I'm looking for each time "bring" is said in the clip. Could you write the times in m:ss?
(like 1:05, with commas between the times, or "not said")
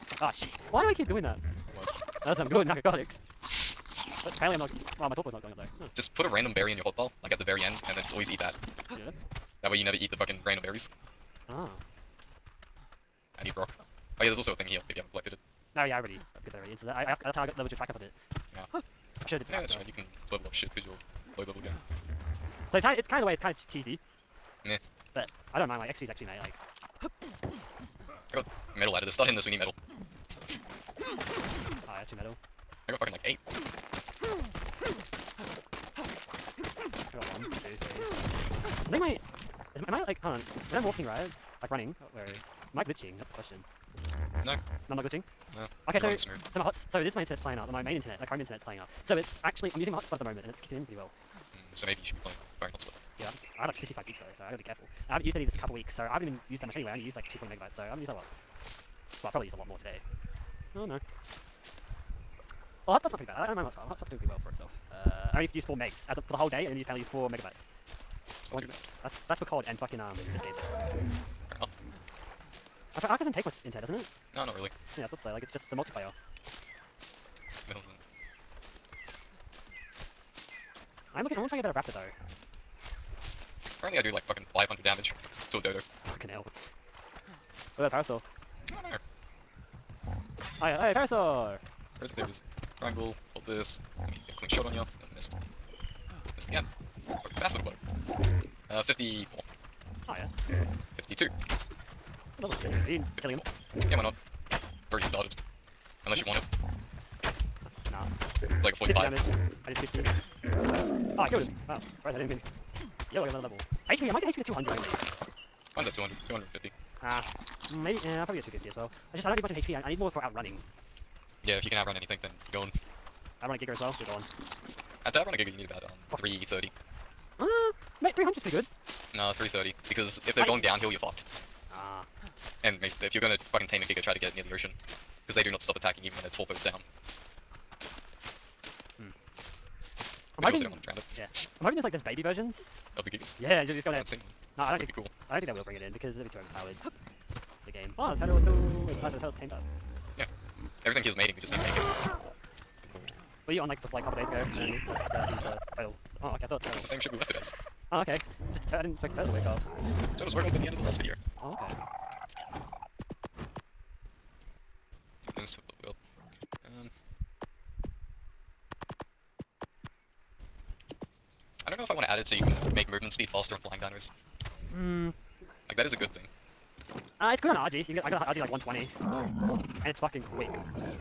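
2:25.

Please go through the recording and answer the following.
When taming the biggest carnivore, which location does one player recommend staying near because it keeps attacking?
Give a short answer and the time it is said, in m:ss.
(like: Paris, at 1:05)
The ocean, at 2:14.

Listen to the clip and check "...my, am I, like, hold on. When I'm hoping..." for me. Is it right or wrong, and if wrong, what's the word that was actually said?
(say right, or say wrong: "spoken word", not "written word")
wrong: "walking", not "hoping".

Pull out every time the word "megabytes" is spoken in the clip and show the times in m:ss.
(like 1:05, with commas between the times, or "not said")
0:57, 1:07.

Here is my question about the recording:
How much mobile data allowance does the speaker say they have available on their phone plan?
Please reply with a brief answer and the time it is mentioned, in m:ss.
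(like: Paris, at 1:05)
55 gigs, at 0:53.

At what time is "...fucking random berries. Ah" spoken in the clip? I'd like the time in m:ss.
0:10.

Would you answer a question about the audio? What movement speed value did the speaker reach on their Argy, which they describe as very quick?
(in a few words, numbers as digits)
120.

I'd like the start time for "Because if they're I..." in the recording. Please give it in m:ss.
2:09.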